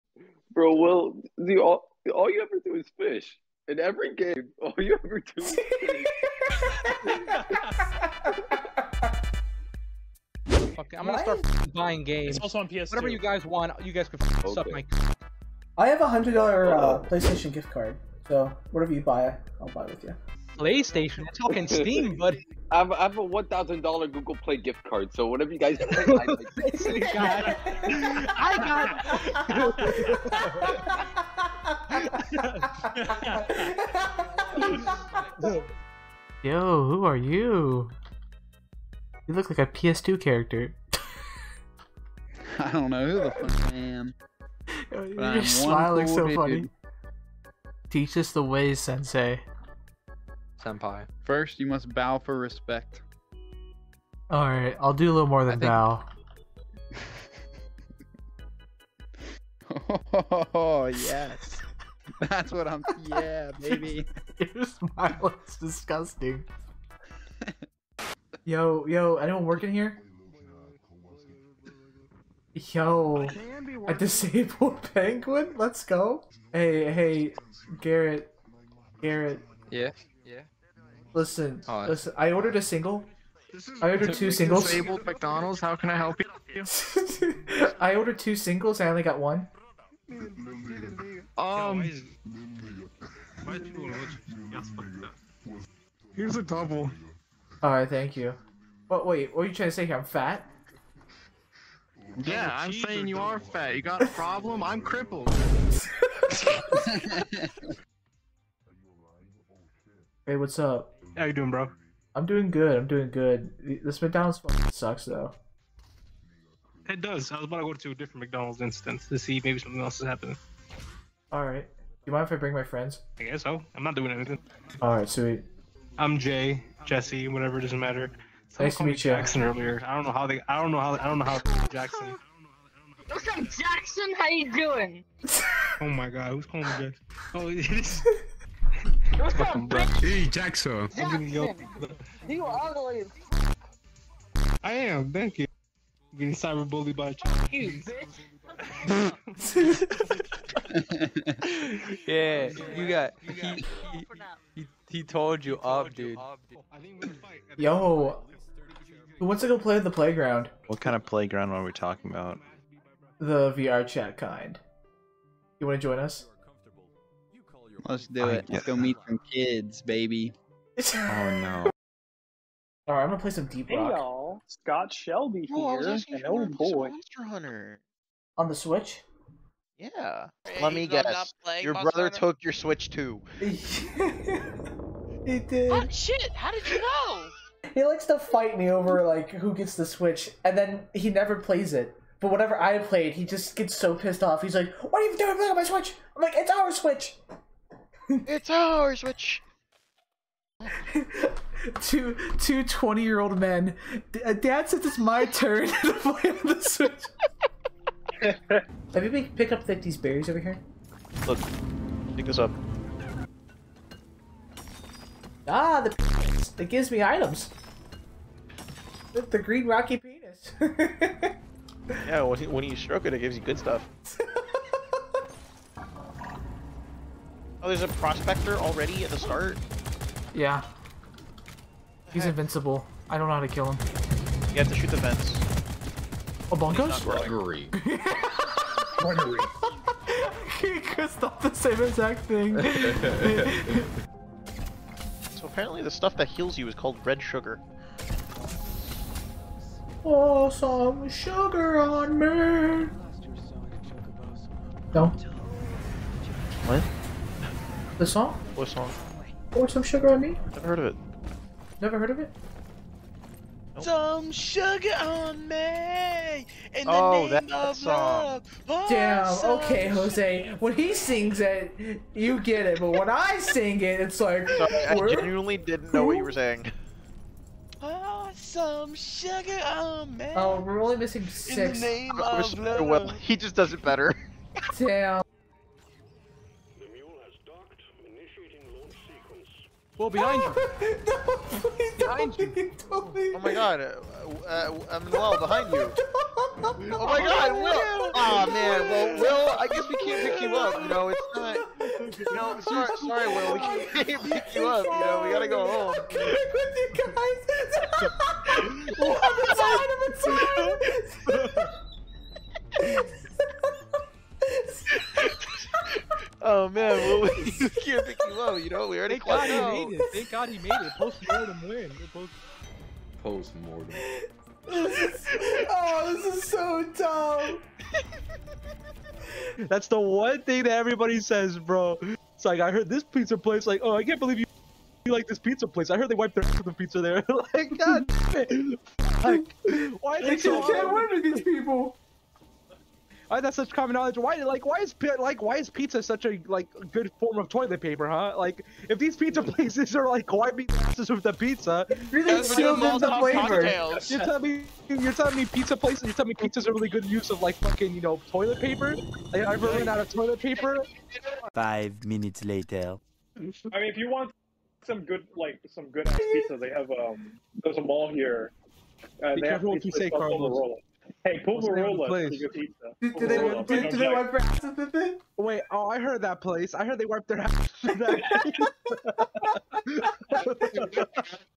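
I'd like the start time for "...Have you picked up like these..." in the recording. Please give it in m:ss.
3:28.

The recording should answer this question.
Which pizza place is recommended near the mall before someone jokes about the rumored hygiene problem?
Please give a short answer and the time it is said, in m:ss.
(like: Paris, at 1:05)
Pulverola, at 6:11.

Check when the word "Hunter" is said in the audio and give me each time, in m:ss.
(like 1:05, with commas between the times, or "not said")
2:57, 3:02.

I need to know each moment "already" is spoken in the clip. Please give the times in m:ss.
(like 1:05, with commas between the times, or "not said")
3:48, 5:18.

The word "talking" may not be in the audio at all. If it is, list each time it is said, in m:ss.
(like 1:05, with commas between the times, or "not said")
0:21, 2:41.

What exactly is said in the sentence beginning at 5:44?
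Why, like, why is like, why is pizza such a like good form of toilet paper, huh?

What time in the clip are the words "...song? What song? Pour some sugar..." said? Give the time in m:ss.
4:18.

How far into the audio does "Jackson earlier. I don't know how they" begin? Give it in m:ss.
2:09.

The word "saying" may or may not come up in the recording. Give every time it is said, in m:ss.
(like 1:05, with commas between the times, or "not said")
1:42, 4:36.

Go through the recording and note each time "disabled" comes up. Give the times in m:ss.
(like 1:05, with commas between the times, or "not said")
1:13, 1:24.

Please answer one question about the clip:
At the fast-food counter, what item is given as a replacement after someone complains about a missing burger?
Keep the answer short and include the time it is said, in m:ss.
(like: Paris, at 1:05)
A double, at 1:36.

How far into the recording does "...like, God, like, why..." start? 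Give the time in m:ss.
5:37.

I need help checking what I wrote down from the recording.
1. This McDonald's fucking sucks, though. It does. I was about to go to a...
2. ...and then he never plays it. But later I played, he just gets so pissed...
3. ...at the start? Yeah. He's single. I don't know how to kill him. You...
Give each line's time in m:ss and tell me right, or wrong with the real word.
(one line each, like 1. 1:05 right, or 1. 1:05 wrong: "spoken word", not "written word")
1. 1:53 right
2. 3:10 wrong: "whenever", not "later"
3. 3:49 wrong: "invincible", not "single".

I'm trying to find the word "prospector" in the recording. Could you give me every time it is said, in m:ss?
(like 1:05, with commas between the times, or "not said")
3:47.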